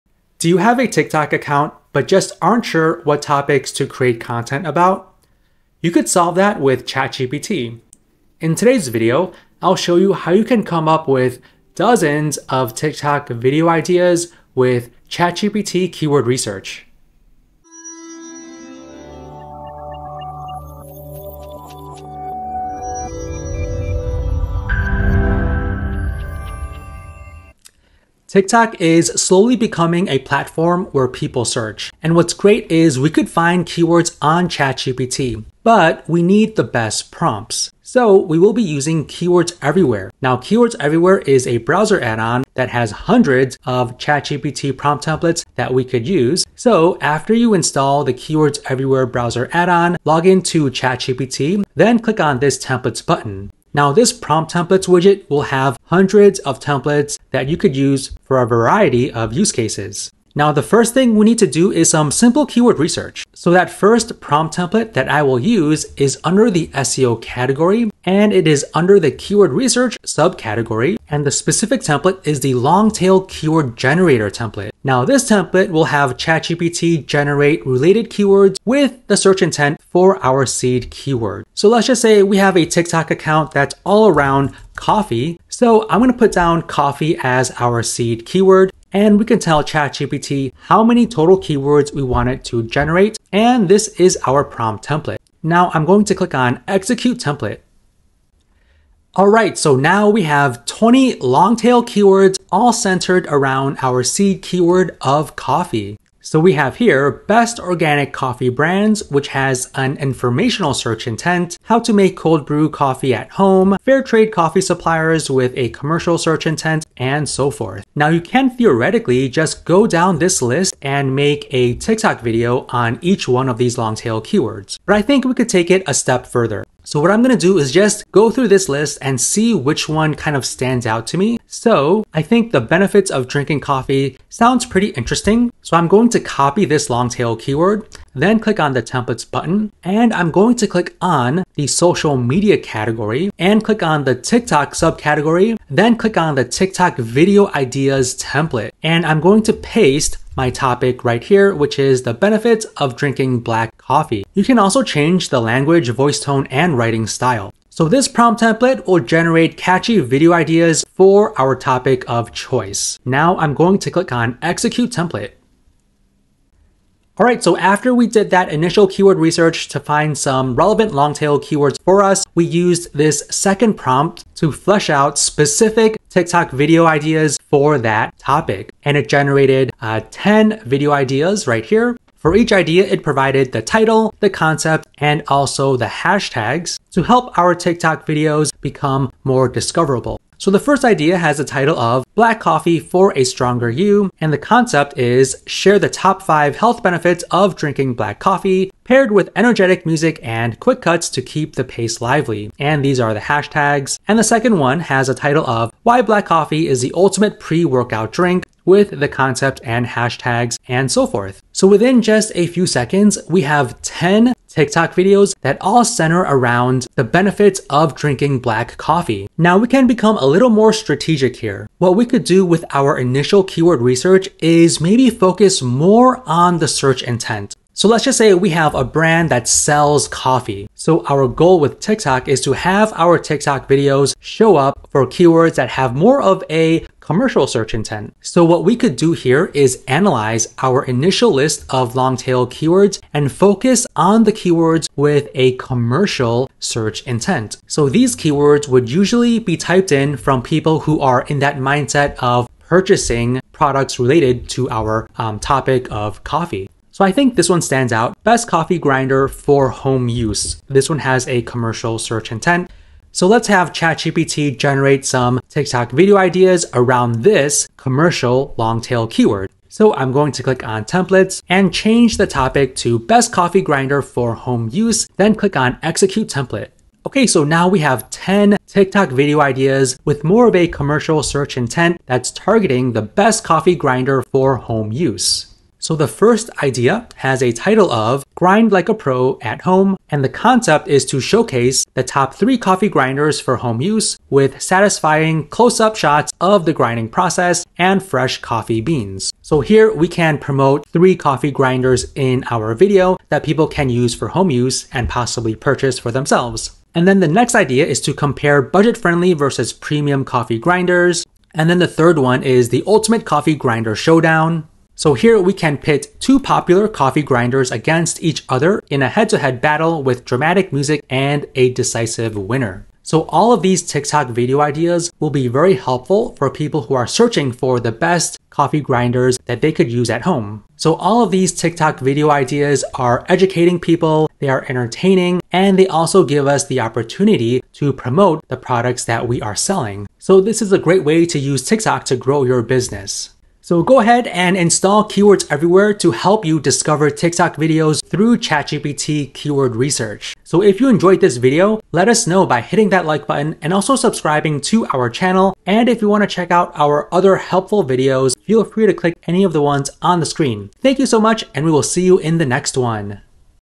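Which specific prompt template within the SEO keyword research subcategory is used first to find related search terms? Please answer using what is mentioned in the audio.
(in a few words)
long tail keyword generator.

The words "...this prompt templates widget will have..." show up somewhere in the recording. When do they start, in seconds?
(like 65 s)
53 s.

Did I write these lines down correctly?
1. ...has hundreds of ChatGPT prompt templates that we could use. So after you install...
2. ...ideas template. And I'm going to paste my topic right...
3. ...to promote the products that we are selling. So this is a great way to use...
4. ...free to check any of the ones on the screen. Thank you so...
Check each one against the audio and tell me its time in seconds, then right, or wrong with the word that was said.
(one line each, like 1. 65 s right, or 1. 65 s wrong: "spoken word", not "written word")
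1. 42 s right
2. 147 s right
3. 337 s right
4. 358 s wrong: "click", not "check".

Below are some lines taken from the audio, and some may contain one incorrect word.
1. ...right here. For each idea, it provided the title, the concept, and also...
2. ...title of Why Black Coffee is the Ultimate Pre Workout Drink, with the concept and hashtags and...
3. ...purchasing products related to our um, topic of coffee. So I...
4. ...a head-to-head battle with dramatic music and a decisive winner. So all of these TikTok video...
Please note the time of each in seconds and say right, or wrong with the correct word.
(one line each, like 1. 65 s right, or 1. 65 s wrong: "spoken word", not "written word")
1. 181 s right
2. 205 s right
3. 252 s right
4. 319 s right.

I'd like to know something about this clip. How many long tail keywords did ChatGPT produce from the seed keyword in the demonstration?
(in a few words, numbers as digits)
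20.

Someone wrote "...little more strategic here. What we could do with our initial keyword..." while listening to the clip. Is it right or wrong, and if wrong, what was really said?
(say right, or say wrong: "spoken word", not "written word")
right.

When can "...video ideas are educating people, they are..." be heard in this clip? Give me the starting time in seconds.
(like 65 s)
331 s.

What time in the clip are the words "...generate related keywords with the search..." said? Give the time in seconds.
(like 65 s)
77 s.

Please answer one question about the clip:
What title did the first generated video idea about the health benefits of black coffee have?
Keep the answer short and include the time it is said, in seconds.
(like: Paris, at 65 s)
Black Coffee for a Stronger You, at 192 s.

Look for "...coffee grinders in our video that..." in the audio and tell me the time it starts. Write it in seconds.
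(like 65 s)
301 s.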